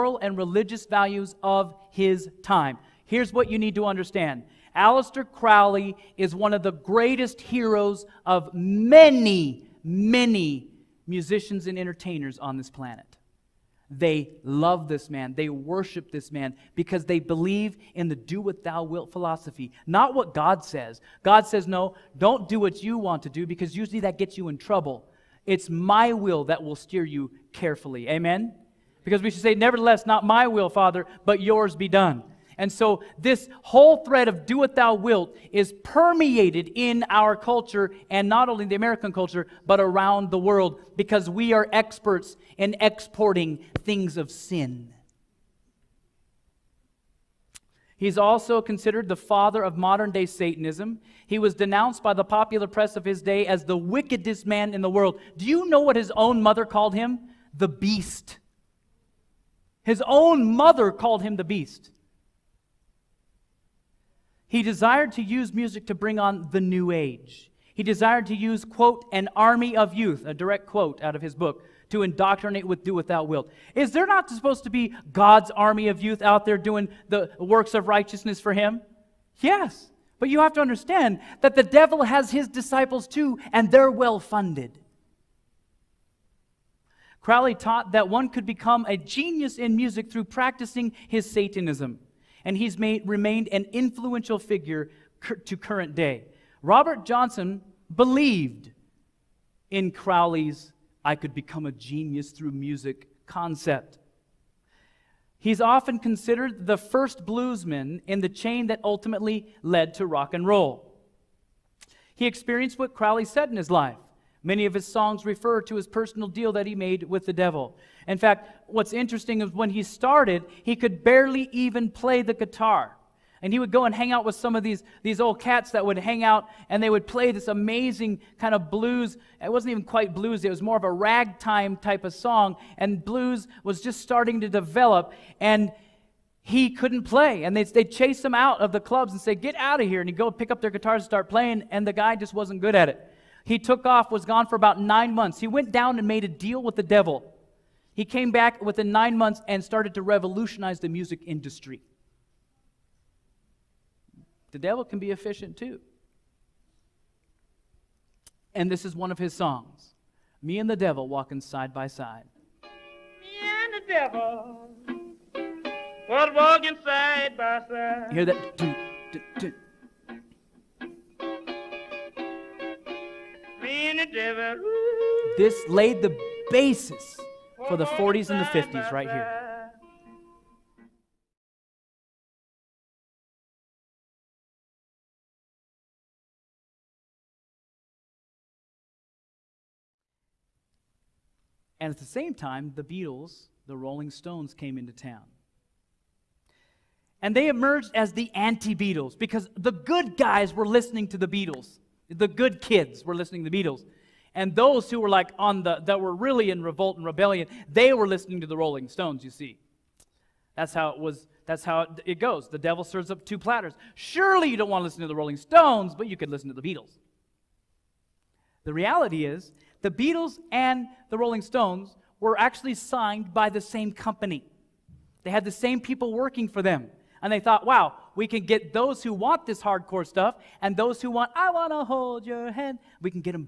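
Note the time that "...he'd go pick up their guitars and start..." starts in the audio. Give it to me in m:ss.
2:20.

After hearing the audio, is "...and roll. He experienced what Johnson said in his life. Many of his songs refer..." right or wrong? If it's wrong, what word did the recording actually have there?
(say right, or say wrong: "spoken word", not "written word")
wrong: "Crowley", not "Johnson".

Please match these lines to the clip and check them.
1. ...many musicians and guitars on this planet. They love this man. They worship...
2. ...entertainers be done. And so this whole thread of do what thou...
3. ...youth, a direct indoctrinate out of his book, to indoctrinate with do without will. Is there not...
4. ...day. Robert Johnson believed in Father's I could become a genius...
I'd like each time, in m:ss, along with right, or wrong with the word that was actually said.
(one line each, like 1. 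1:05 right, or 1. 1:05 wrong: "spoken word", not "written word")
1. 0:09 wrong: "entertainers", not "guitars"
2. 0:31 wrong: "yours", not "entertainers"
3. 1:09 wrong: "quote", not "indoctrinate"
4. 1:35 wrong: "Crowley", not "Father".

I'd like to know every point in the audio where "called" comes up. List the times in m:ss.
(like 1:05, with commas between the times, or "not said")
0:56, 1:00.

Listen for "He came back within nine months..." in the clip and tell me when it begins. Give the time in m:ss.
2:27.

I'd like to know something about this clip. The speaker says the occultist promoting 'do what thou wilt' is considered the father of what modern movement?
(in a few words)
modern day Satanism.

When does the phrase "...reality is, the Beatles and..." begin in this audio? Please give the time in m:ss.
3:38.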